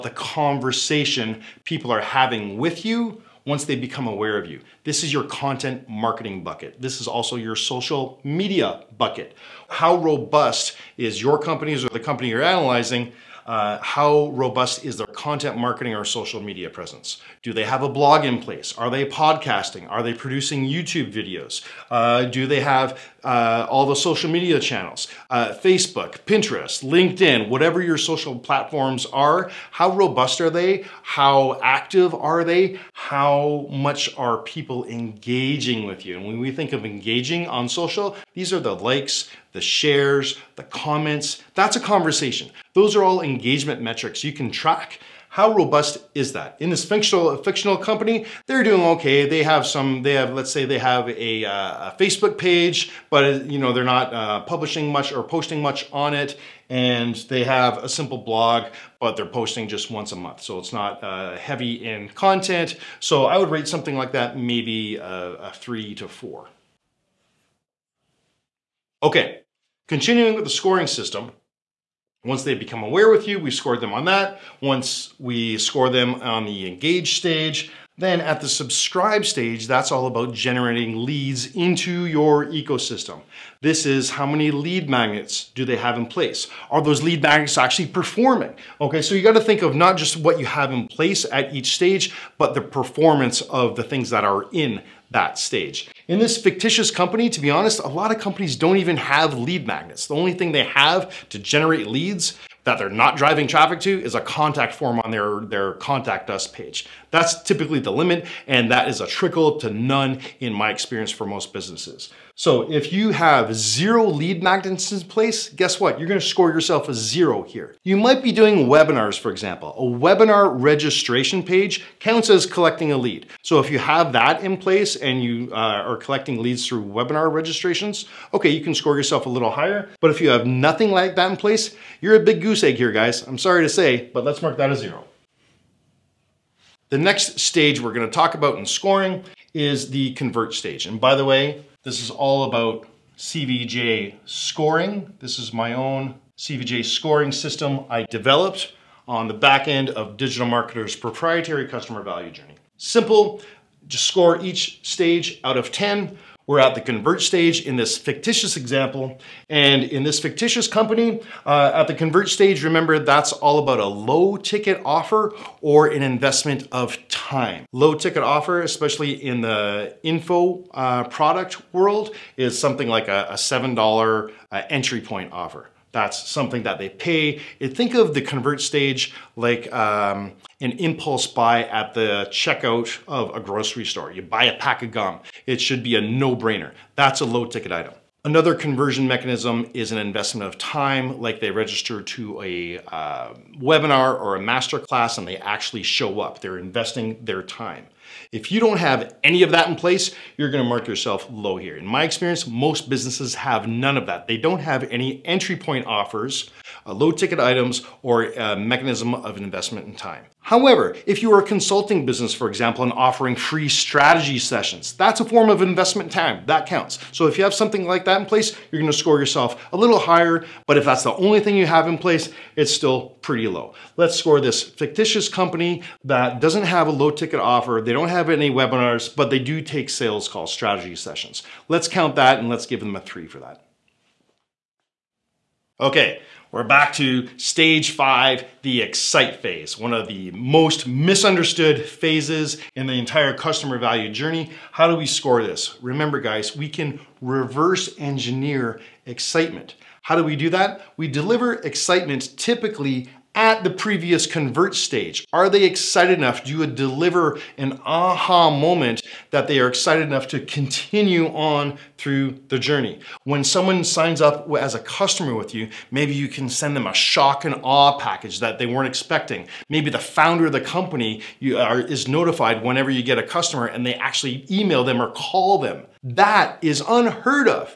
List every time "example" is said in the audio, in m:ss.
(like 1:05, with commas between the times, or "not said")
1:59, 2:38, 3:32.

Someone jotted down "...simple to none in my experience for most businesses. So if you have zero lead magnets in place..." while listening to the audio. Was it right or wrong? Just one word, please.
wrong.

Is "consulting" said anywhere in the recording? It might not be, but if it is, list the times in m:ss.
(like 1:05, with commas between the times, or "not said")
3:31.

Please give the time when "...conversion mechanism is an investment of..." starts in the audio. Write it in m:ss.
3:08.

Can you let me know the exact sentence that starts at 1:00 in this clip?
So it's not uh, heavy in content.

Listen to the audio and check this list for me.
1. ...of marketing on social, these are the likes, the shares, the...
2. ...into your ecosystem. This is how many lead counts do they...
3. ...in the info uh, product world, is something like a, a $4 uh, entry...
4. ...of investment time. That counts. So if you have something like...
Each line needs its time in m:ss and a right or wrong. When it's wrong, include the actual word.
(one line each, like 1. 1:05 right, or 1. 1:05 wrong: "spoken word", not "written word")
1. 0:36 wrong: "engaging", not "marketing"
2. 1:21 wrong: "magnets", not "counts"
3. 2:49 wrong: "7", not "4"
4. 3:35 right.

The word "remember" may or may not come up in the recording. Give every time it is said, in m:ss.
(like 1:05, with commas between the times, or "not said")
2:42, 4:05.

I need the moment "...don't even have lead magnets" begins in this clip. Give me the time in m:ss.
1:38.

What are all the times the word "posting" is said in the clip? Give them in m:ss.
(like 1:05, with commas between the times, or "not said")
0:55, 0:59.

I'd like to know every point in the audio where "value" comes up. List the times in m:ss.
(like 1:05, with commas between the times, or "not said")
2:32, 4:03.